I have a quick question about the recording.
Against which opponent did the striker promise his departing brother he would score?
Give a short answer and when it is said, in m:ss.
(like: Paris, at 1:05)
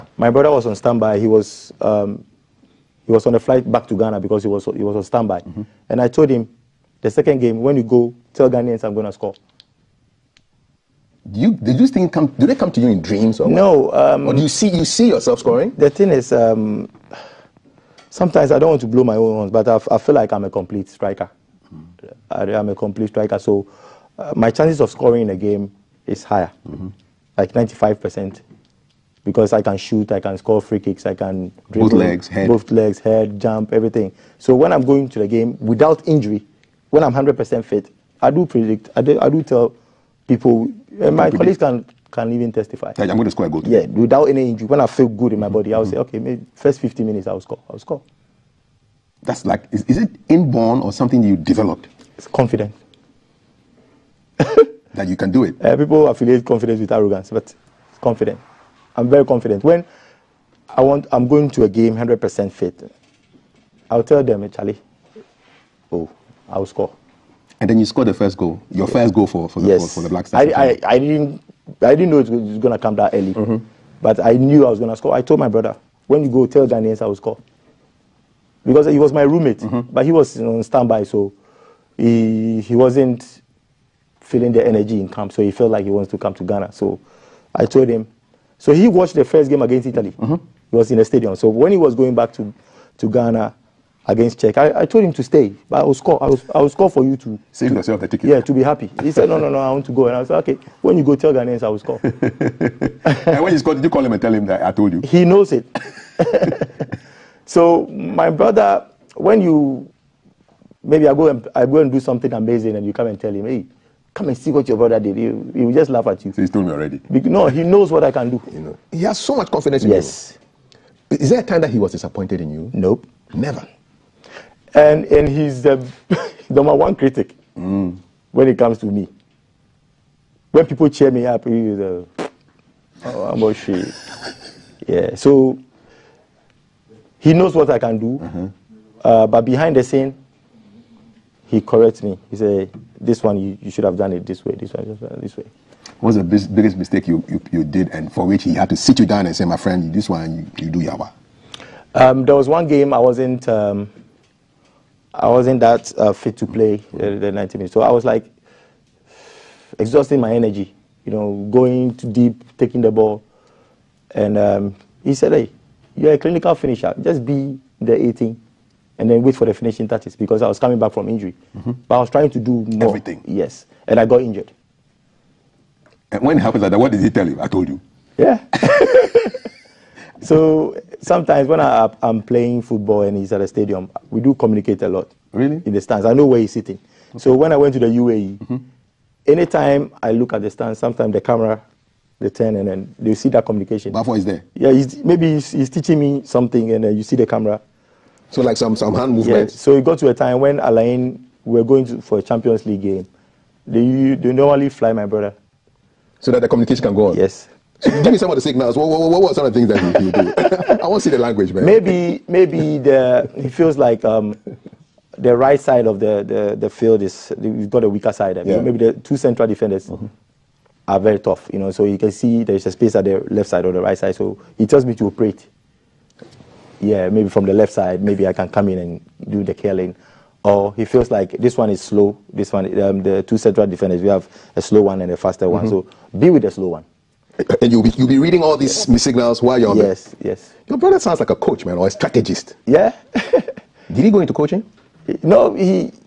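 Czech, at 1:34.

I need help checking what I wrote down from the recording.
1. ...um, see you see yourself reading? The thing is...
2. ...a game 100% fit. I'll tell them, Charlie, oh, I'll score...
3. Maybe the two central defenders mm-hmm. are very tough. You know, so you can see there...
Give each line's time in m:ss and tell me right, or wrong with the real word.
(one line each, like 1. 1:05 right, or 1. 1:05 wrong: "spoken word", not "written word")
1. 0:14 wrong: "scoring", not "reading"
2. 1:01 right
3. 3:38 right.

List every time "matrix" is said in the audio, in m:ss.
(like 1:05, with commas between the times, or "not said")
not said.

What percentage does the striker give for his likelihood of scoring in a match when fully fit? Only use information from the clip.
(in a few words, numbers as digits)
95 percent.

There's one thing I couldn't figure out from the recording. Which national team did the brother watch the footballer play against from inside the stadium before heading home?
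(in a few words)
Italy.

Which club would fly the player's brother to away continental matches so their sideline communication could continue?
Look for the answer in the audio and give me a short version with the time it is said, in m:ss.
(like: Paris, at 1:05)
Al Ain, at 3:20.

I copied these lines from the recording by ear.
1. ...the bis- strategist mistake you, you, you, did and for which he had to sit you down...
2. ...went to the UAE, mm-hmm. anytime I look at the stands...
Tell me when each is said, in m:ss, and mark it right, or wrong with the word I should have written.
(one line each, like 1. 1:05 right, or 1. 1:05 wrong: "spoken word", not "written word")
1. 2:26 wrong: "biggest", not "strategist"
2. 3:07 right.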